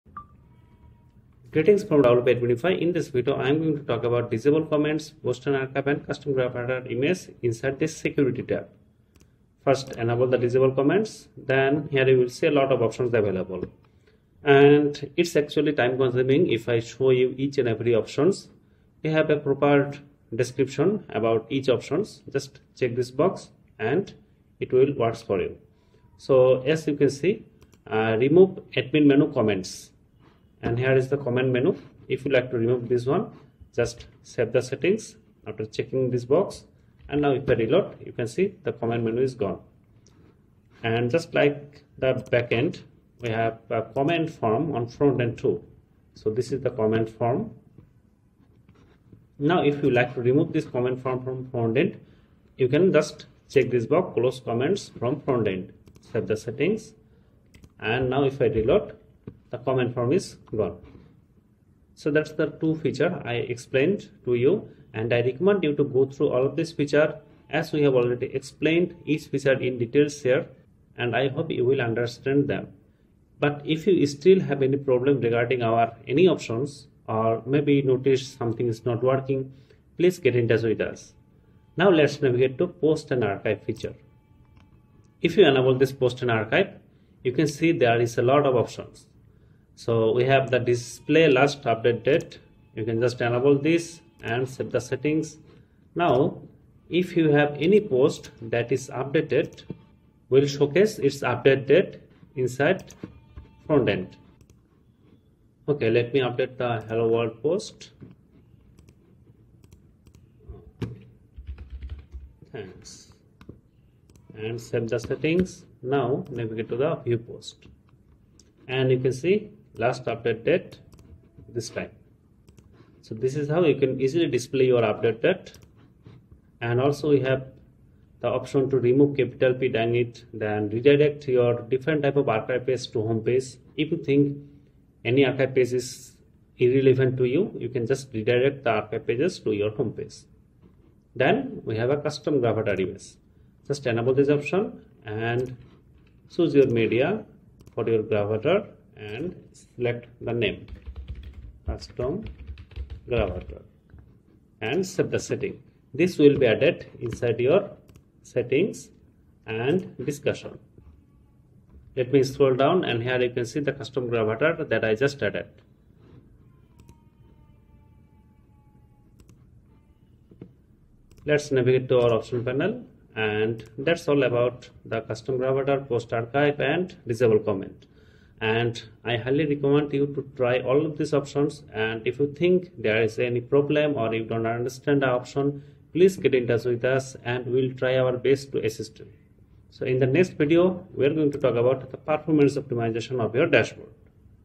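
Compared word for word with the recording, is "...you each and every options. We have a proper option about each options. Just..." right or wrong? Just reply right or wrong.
wrong.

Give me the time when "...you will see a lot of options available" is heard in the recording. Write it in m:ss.
0:12.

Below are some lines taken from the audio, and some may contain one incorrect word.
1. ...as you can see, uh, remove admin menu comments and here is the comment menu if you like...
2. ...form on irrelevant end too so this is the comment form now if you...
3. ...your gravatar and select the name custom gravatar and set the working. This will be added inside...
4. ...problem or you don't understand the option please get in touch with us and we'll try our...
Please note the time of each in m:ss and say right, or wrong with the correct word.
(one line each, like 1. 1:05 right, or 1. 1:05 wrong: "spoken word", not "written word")
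1. 0:26 right
2. 0:44 wrong: "front", not "irrelevant"
3. 2:27 wrong: "setting", not "working"
4. 3:03 right.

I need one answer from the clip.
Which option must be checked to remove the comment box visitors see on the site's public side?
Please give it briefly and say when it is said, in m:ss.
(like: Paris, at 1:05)
Close comments from front end, at 0:54.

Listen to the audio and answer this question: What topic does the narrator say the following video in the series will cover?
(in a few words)
Performance optimization.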